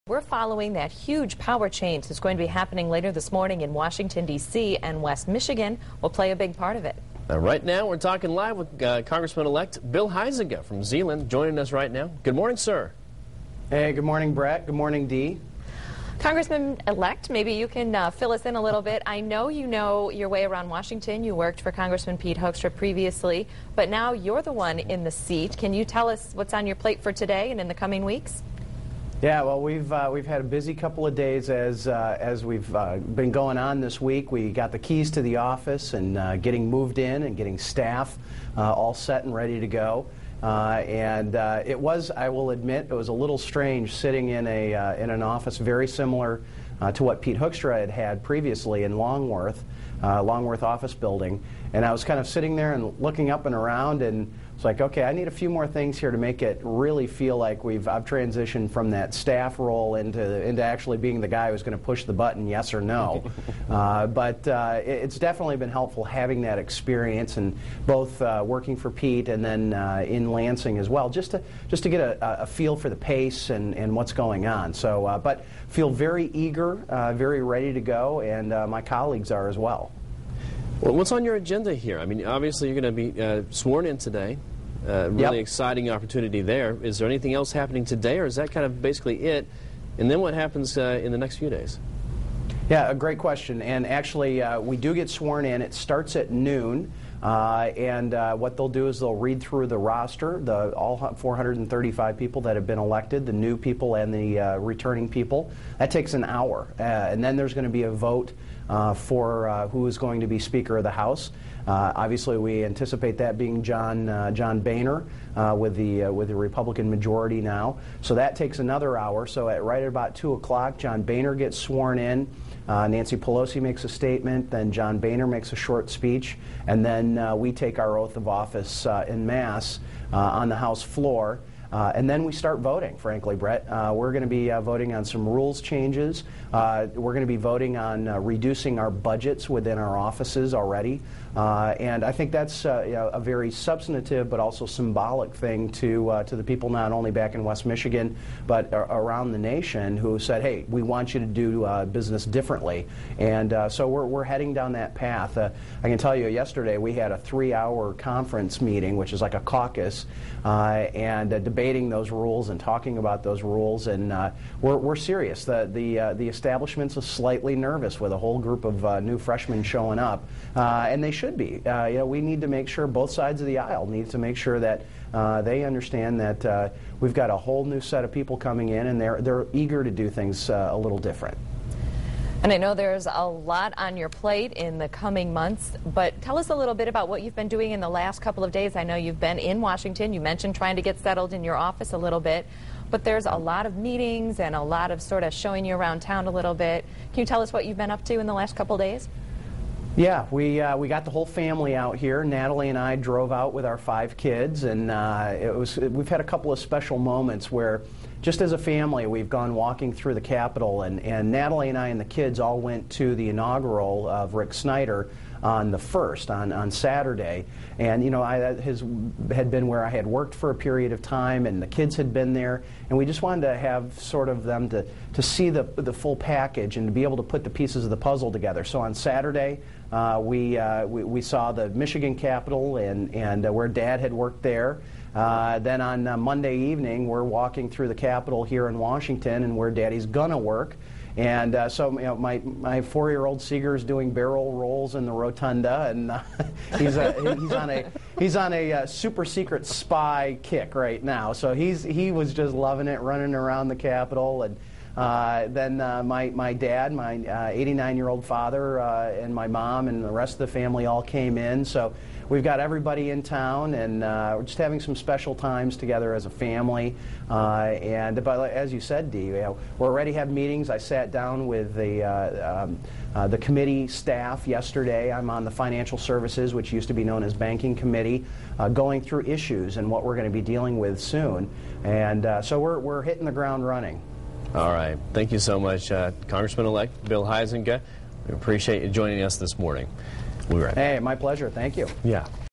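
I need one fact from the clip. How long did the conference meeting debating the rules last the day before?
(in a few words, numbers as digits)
3 hours.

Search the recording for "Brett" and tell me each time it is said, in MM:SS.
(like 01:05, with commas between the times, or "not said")
00:14, 02:13.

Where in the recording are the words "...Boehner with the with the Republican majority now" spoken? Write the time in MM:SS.
01:54.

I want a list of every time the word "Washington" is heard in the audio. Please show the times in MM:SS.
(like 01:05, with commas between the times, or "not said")
00:03, 00:20, 03:09, 03:58.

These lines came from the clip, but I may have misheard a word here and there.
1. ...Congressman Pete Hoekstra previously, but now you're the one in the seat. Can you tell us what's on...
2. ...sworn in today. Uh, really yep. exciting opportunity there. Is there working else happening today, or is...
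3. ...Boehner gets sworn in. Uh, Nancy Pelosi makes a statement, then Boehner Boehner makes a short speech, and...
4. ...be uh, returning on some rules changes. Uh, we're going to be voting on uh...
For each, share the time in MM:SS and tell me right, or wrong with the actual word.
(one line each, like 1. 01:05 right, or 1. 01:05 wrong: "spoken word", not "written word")
1. 00:21 right
2. 01:23 wrong: "anything", not "working"
3. 02:01 wrong: "John", not "Boehner"
4. 02:14 wrong: "voting", not "returning".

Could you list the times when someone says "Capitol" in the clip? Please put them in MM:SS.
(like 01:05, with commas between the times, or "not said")
03:30, 03:52, 03:57, 04:13.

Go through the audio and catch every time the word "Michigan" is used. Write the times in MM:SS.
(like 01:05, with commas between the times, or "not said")
00:05, 02:27, 03:51.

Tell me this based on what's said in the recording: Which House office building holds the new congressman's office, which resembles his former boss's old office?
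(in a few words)
Longworth.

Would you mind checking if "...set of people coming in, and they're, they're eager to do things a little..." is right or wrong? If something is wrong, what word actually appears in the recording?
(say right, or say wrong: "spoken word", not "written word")
right.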